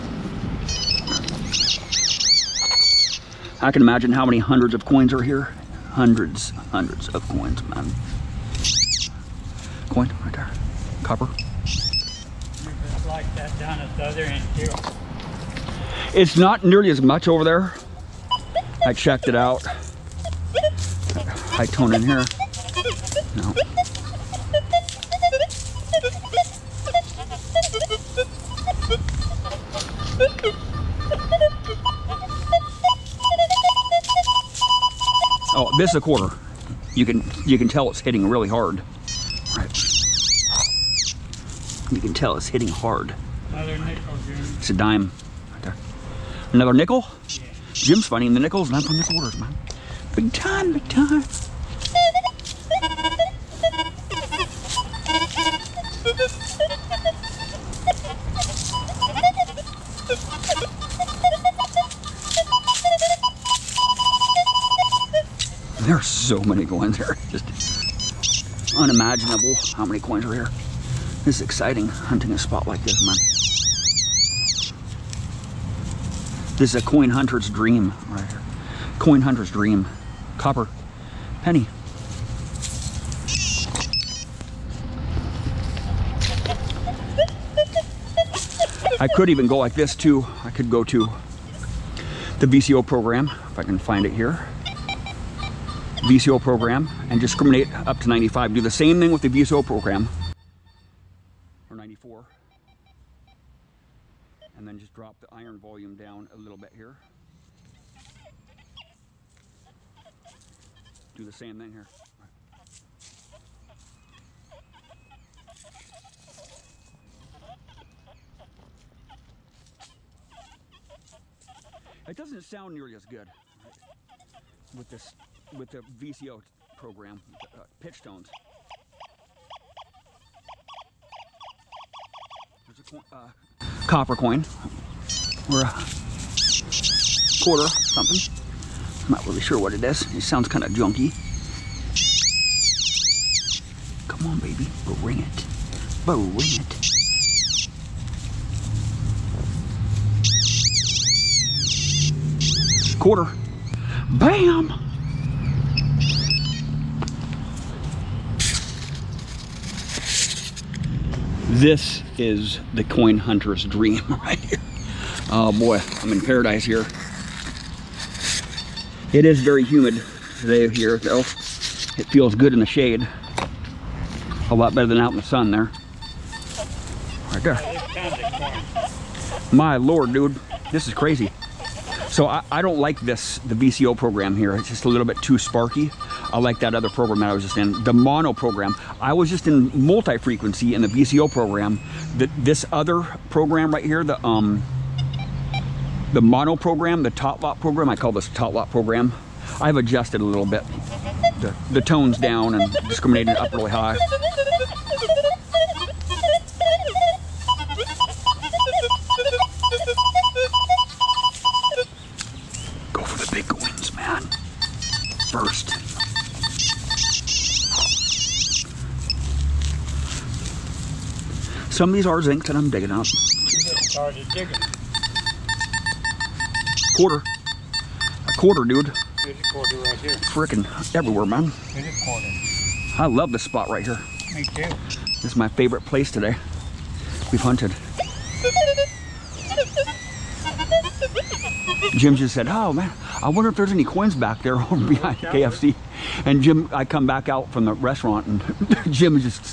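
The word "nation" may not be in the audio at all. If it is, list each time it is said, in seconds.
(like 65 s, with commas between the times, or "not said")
not said.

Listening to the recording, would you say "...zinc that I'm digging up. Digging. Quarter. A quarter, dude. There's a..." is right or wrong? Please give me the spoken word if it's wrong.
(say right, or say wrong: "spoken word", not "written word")
right.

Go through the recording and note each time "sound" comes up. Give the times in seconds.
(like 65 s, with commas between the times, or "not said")
122 s, 140 s.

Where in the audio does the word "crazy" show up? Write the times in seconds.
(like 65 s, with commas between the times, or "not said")
180 s.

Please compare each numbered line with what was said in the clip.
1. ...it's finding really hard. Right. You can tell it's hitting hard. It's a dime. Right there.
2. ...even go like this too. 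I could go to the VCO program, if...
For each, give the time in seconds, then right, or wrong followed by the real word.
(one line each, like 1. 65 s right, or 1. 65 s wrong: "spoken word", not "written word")
1. 37 s wrong: "hitting", not "finding"
2. 89 s right.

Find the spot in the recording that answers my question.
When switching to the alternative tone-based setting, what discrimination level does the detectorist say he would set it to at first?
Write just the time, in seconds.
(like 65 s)
98 s.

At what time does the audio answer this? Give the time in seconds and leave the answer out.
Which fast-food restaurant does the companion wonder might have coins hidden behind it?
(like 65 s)
245 s.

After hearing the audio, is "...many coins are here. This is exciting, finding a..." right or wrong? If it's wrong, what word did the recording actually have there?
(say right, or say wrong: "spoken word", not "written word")
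wrong: "hunting", not "finding".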